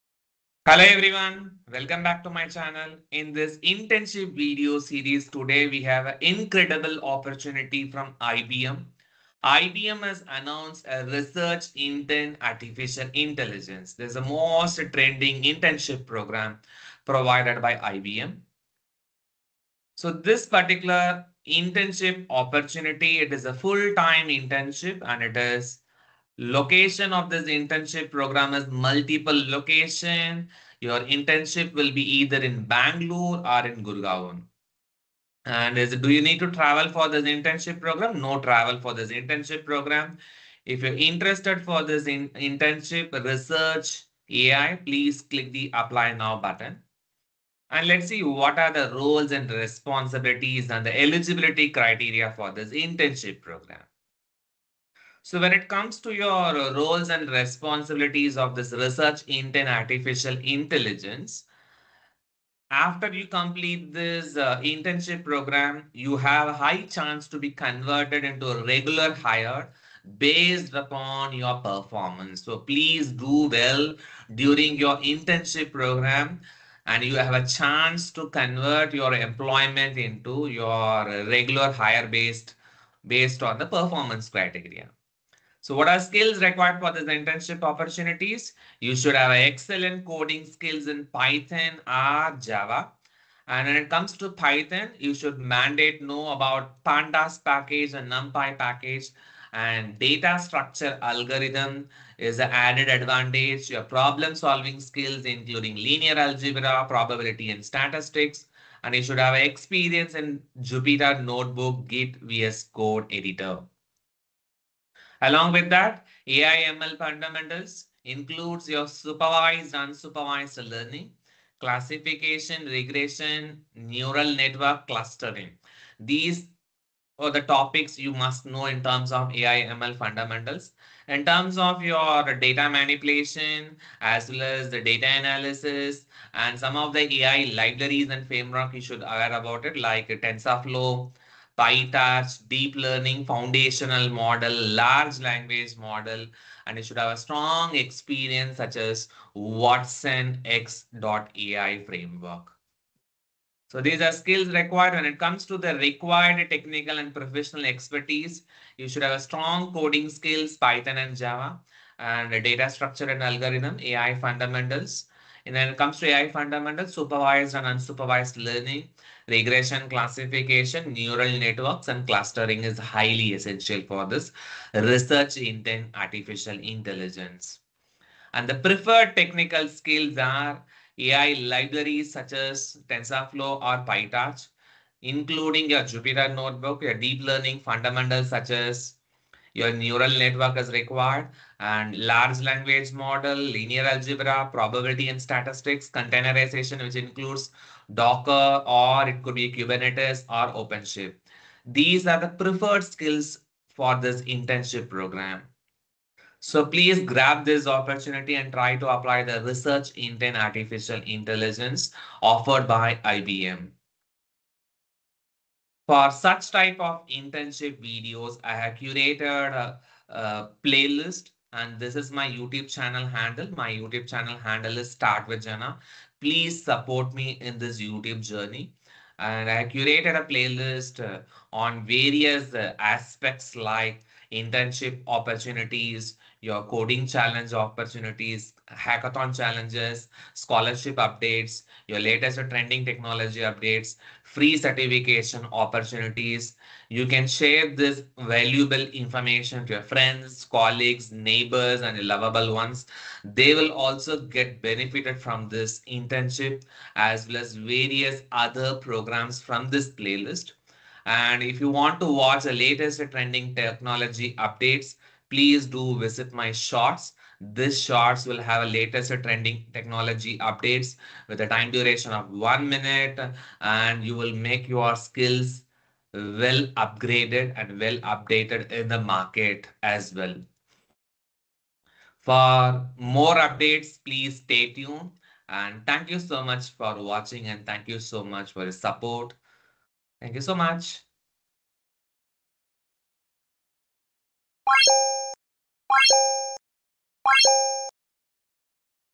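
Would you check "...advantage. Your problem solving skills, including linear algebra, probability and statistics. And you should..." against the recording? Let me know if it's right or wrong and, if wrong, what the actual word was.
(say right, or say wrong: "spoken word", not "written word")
right.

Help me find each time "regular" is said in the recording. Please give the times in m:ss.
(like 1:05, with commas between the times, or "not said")
1:08, 1:21.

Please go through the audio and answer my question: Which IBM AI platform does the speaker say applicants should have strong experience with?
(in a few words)
watsonx.ai.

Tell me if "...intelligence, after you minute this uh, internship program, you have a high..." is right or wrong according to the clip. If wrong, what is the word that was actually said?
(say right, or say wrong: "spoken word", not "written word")
wrong: "complete", not "minute".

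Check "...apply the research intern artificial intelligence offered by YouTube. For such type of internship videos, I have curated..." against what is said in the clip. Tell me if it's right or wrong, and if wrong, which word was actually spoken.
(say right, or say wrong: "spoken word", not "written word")
wrong: "IBM", not "YouTube".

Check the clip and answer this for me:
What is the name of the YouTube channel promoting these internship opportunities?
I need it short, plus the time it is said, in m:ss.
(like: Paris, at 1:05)
Start with Jana, at 3:44.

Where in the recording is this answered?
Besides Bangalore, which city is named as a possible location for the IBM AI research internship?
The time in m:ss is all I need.
0:33.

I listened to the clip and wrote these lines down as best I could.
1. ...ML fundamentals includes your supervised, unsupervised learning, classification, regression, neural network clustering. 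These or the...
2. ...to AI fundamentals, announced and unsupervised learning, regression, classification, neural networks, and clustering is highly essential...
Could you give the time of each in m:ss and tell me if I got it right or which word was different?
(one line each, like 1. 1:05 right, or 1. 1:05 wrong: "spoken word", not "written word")
1. 1:56 right
2. 2:45 wrong: "supervised", not "announced".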